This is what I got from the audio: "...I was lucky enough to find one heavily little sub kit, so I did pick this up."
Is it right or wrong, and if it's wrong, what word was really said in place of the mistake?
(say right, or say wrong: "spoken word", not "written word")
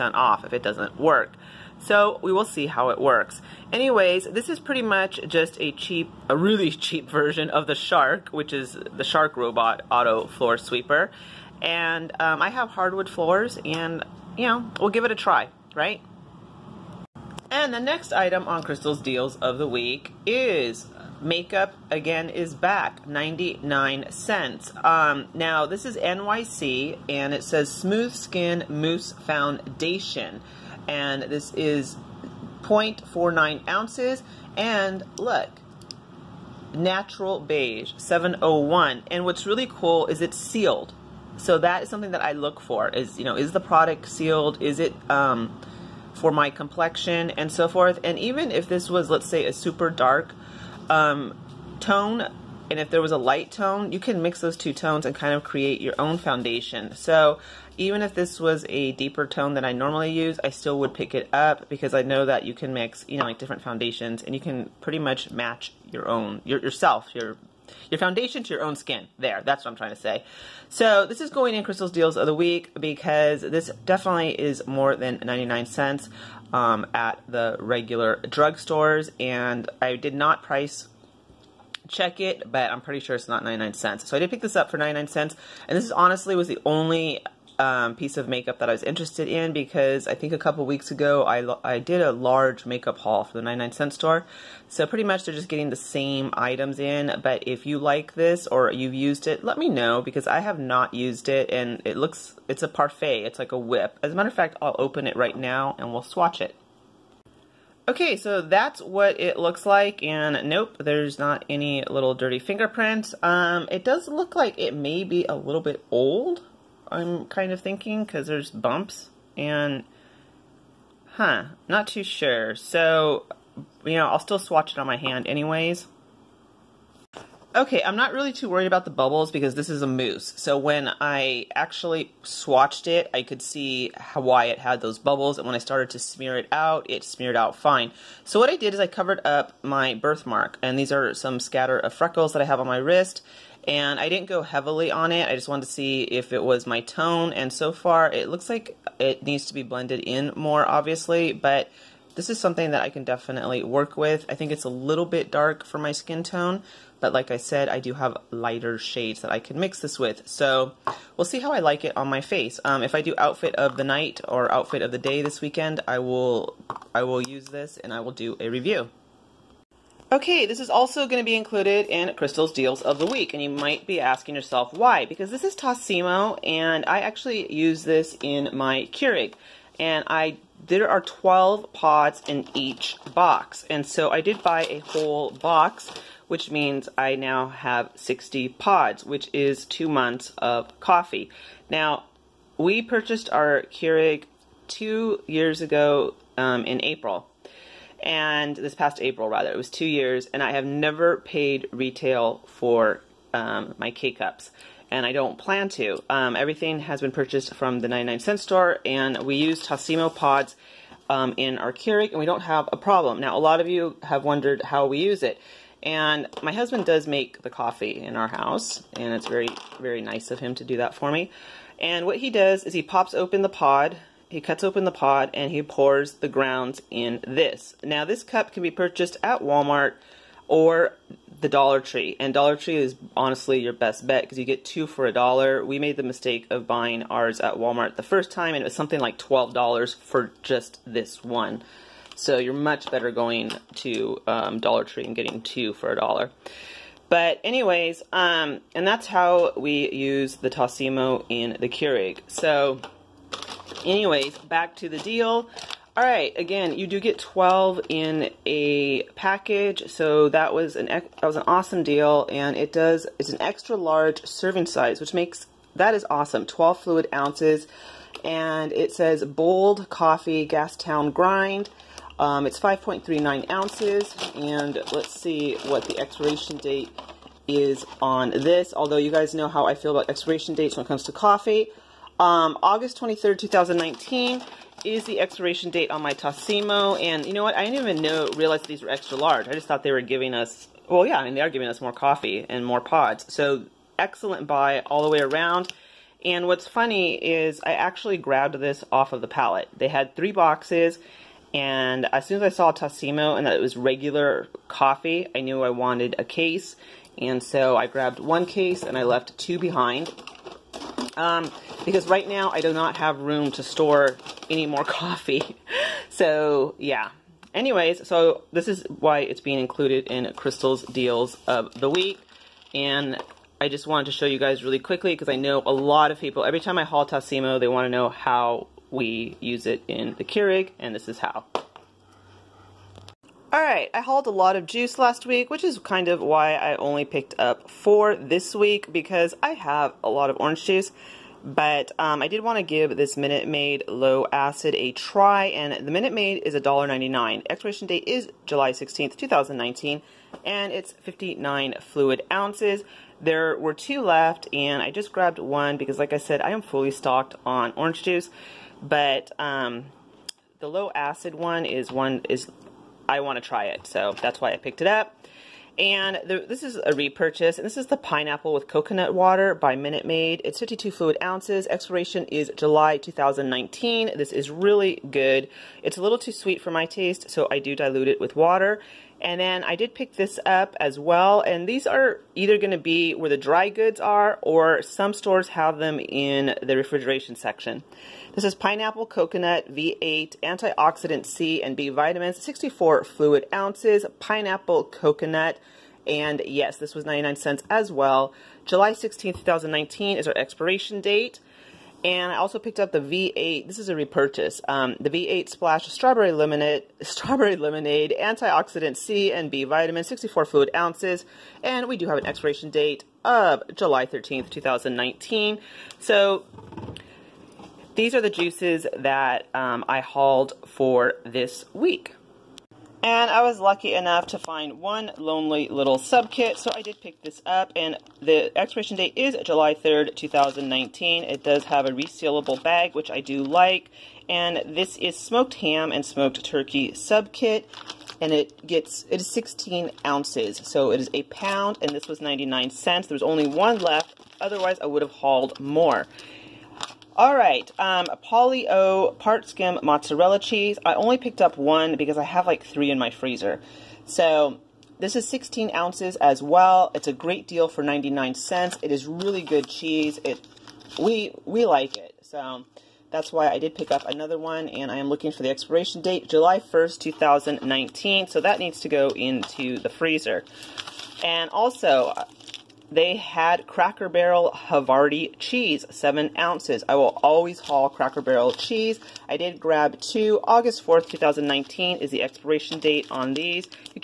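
wrong: "lonely", not "heavily".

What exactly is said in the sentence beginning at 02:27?
And so far, it looks like it needs to be blended in more, obviously.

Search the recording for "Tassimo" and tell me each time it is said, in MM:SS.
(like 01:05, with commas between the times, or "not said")
02:55, 03:29, 04:10, 04:46, 05:02, 05:27.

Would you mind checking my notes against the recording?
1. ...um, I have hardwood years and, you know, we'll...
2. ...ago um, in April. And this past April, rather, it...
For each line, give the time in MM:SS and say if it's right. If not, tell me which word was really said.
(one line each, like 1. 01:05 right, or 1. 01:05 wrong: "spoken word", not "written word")
1. 00:12 wrong: "floors", not "years"
2. 03:15 right.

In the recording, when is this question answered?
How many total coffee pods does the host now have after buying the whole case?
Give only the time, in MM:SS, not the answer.
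03:07.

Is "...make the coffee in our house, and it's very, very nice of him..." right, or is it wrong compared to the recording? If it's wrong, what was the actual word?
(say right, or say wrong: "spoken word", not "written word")
right.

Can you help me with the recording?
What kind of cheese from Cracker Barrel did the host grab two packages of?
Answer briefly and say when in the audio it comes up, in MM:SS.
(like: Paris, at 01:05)
Havarti, at 07:54.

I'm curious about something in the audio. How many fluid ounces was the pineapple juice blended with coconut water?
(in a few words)
52 fluid ounces.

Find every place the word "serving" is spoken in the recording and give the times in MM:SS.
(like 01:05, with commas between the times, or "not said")
04:24.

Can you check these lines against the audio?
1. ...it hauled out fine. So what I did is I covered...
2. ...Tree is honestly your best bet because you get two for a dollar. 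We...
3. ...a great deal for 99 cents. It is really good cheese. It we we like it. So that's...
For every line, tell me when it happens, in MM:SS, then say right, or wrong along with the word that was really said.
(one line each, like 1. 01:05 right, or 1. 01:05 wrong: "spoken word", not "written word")
1. 02:16 wrong: "smeared", not "hauled"
2. 03:52 right
3. 07:37 right.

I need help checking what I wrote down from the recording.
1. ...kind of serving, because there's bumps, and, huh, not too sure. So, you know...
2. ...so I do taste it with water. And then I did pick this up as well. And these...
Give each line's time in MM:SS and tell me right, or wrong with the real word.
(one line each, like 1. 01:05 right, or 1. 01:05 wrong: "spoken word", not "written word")
1. 01:57 wrong: "thinking", not "serving"
2. 06:17 wrong: "dilute", not "taste".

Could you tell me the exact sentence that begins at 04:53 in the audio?
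So excellent buy all the way around.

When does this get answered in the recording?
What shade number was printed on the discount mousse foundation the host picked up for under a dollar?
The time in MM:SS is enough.
00:37.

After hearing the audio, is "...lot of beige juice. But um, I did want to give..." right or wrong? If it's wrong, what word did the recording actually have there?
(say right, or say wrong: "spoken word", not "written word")
wrong: "orange", not "beige".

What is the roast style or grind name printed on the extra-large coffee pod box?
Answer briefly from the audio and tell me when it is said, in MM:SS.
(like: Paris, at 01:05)
Gas Town Grind, at 04:30.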